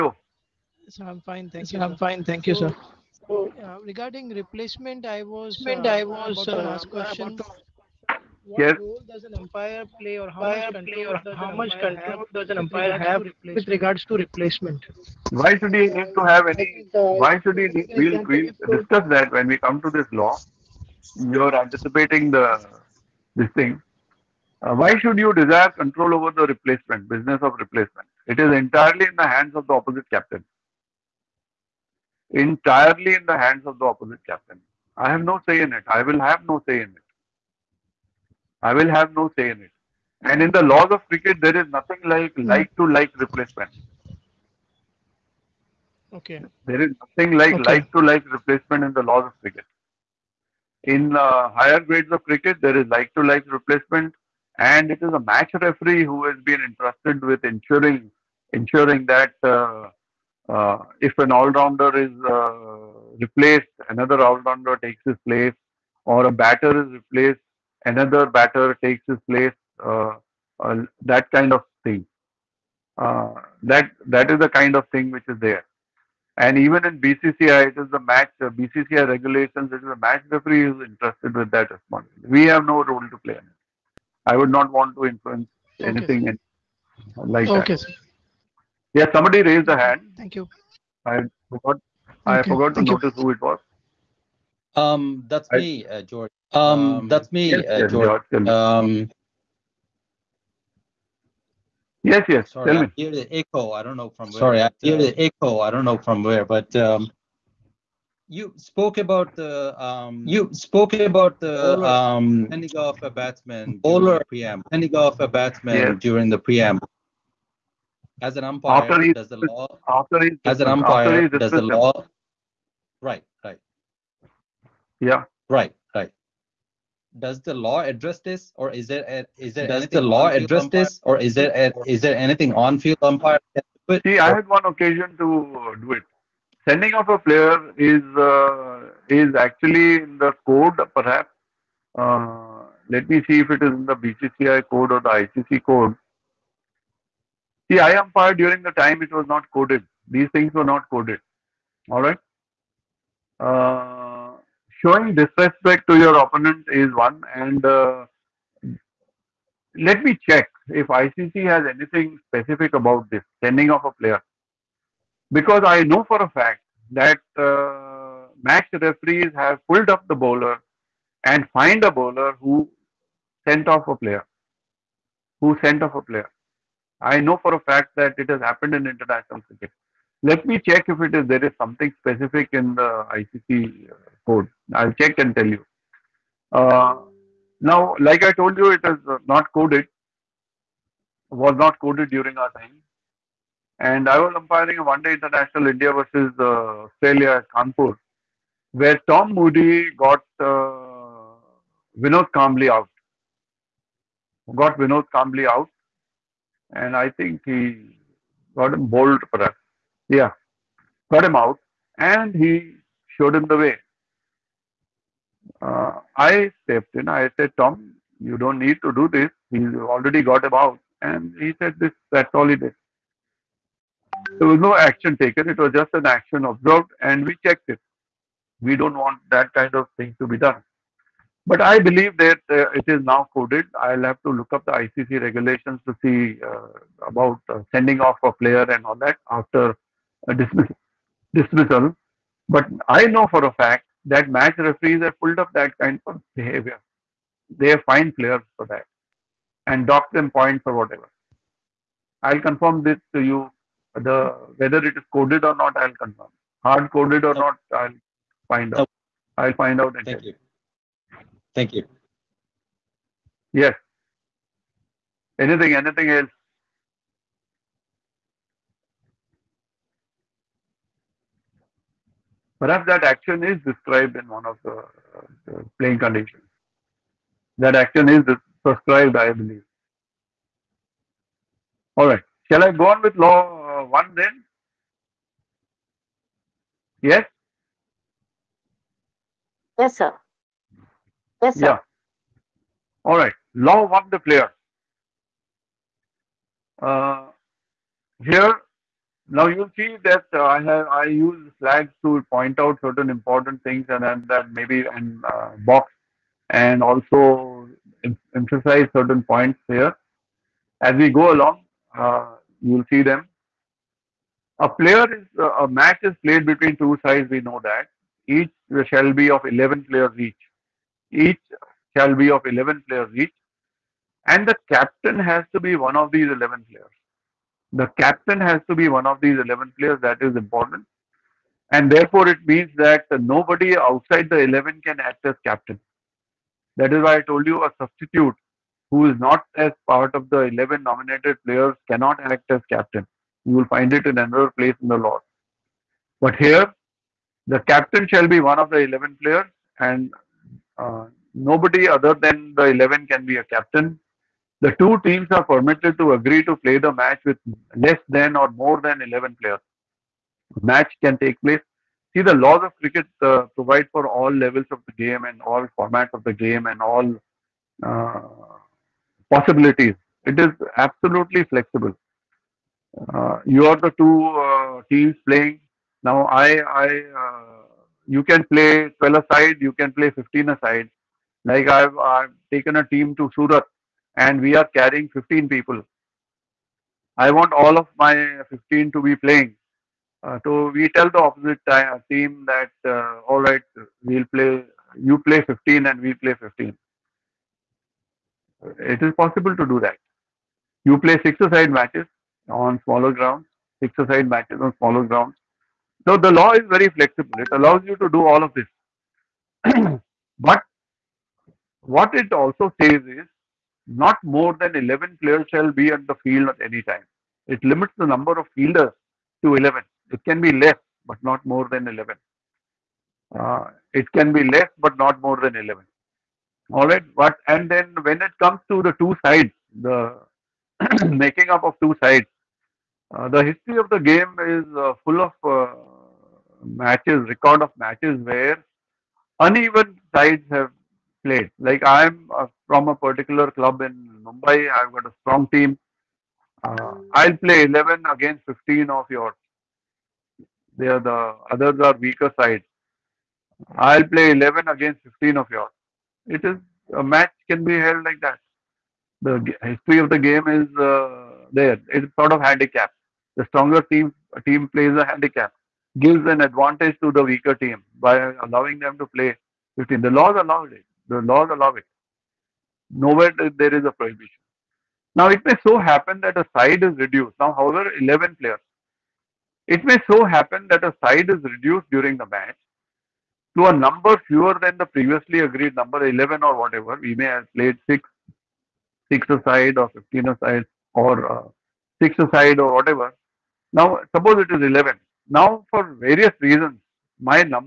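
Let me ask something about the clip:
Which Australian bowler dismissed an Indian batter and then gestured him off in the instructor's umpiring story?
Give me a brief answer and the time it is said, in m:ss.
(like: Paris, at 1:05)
Tom Moody, at 3:19.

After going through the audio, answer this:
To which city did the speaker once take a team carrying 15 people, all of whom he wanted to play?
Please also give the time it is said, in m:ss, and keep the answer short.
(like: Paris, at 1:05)
Surat, at 6:23.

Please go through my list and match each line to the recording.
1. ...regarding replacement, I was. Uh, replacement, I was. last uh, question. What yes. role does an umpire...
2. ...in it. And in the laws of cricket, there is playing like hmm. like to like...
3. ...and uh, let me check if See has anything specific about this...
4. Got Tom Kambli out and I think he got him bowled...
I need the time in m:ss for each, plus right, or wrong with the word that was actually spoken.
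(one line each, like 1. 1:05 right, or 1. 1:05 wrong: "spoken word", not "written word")
1. 0:03 right
2. 0:39 wrong: "nothing", not "playing"
3. 2:37 wrong: "ICC", not "See"
4. 3:24 wrong: "Vinod", not "Tom".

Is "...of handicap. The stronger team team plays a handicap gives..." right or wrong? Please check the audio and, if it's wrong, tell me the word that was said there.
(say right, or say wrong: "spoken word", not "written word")
right.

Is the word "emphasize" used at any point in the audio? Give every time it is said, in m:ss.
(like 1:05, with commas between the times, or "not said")
5:08.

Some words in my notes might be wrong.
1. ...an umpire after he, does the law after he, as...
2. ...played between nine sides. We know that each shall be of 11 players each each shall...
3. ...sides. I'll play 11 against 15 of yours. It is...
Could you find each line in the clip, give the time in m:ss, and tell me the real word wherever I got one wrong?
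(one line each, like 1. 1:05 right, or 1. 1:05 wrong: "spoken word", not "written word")
1. 1:58 right
2. 5:16 wrong: "two", not "nine"
3. 7:32 right.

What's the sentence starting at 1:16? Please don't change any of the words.
And even in BCCI, it is the match uh, BCCI regulations.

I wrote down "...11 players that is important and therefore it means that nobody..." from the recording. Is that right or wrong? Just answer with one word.
right.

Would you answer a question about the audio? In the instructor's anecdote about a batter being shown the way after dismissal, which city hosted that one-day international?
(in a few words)
Kanpur.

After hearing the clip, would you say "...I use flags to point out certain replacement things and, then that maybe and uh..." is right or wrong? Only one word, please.
wrong.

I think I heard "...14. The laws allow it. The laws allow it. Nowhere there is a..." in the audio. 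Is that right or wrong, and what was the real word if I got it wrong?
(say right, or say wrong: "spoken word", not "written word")
wrong: "15", not "14".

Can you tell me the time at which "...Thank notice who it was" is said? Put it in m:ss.
1:32.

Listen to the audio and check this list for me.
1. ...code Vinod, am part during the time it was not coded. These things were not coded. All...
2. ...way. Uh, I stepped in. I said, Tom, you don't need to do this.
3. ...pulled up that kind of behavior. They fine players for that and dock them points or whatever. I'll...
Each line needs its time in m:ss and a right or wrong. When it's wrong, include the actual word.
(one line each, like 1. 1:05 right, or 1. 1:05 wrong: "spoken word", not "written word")
1. 2:25 wrong: "See", not "Vinod"
2. 3:33 right
3. 4:05 right.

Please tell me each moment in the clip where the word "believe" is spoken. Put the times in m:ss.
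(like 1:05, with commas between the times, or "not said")
3:51, 4:39.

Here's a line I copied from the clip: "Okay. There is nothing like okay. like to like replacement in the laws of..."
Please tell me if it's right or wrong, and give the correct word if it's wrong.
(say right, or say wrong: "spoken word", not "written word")
right.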